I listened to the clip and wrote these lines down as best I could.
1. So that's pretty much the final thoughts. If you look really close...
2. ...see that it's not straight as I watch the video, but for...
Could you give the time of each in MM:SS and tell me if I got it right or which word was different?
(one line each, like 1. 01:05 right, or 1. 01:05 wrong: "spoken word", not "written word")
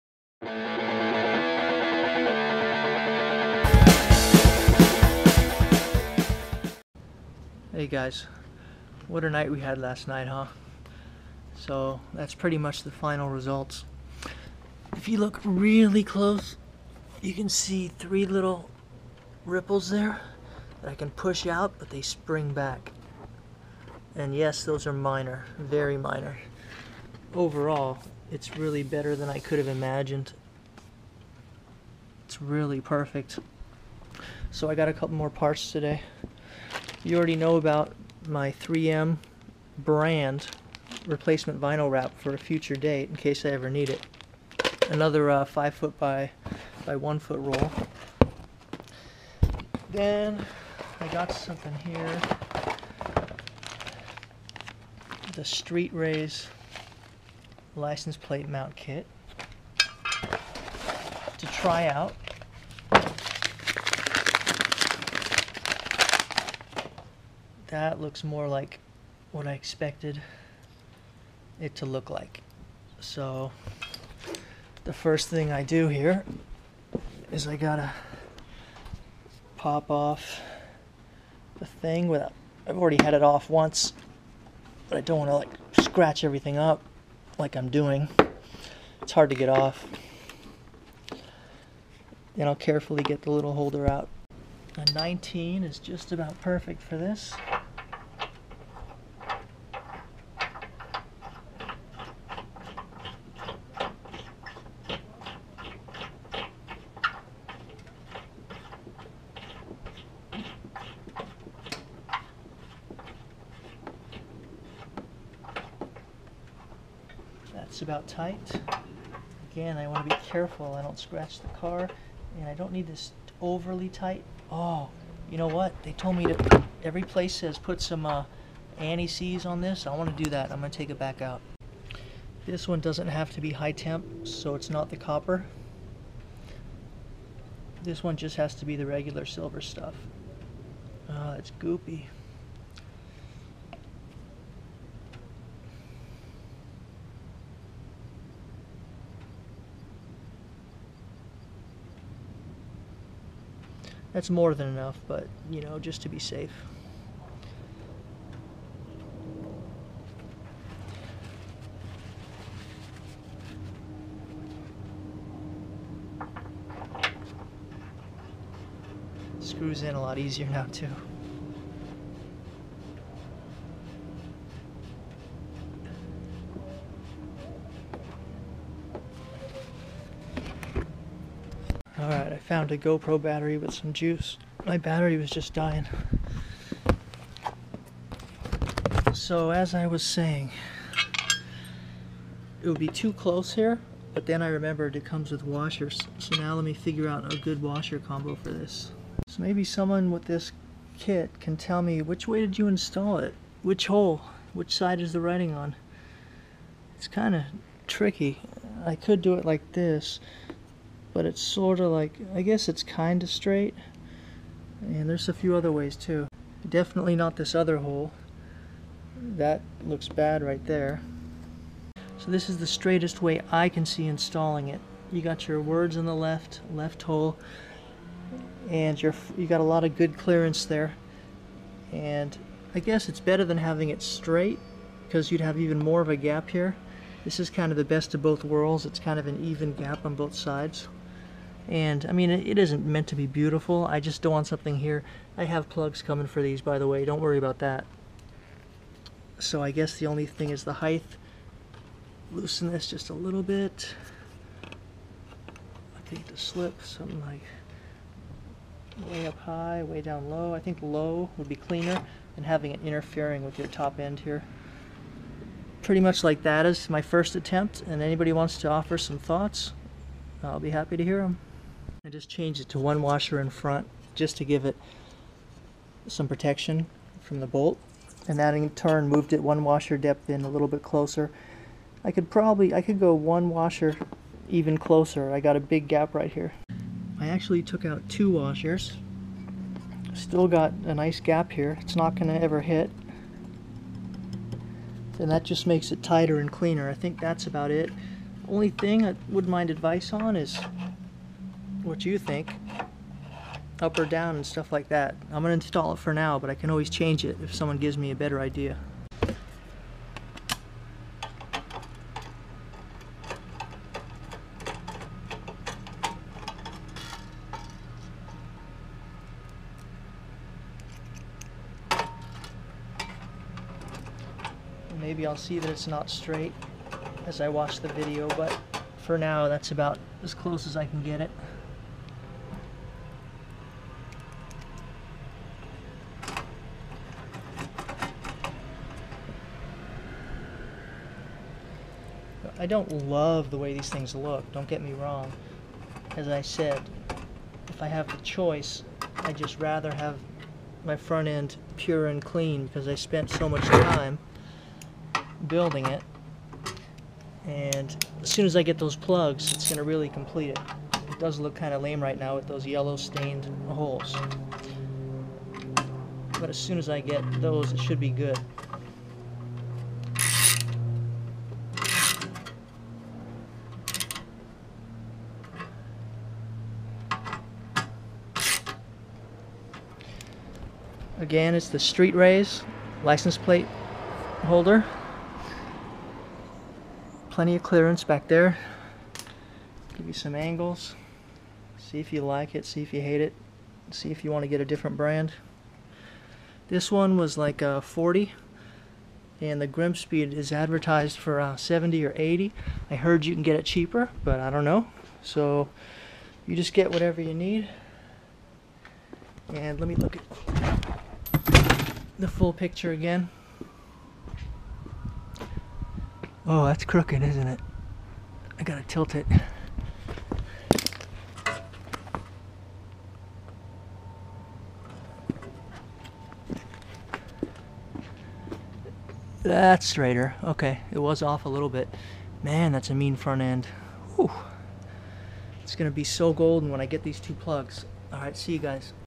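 1. 00:11 wrong: "results", not "thoughts"
2. 05:25 right.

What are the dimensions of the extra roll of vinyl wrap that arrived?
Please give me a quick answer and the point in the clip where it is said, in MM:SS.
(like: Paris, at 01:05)
5 feet by 1 foot, at 00:45.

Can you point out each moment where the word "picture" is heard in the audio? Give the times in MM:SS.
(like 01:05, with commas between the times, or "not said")
06:52.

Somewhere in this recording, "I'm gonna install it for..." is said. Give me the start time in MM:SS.
05:05.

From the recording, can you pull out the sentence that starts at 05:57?
And as soon as I get those plugs, it's going to really complete it.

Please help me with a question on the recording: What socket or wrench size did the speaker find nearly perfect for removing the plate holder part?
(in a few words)
19.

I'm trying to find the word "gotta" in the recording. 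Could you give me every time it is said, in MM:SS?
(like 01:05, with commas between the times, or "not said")
01:17, 06:58.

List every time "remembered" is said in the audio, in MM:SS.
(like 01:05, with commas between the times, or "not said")
03:14.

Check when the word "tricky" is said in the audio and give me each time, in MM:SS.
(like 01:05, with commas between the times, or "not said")
03:27.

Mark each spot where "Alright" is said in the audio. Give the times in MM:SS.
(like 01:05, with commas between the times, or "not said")
03:02, 07:18.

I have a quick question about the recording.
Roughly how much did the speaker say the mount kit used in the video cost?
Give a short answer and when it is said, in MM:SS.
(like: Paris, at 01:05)
40, at 06:37.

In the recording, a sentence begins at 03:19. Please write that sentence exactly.
So maybe someone with this kit can tell me which way did you install it?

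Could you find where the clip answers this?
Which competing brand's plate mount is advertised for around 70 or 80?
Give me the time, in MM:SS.
06:39.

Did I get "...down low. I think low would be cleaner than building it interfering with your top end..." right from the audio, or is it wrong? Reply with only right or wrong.
wrong.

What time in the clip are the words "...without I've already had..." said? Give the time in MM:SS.
01:22.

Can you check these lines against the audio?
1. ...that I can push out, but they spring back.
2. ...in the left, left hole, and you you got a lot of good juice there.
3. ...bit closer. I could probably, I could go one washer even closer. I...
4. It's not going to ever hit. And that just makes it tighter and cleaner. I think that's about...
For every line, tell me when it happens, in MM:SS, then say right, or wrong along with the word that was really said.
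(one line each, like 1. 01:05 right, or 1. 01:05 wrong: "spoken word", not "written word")
1. 00:20 right
2. 03:45 wrong: "clearance", not "juice"
3. 04:40 right
4. 04:51 right.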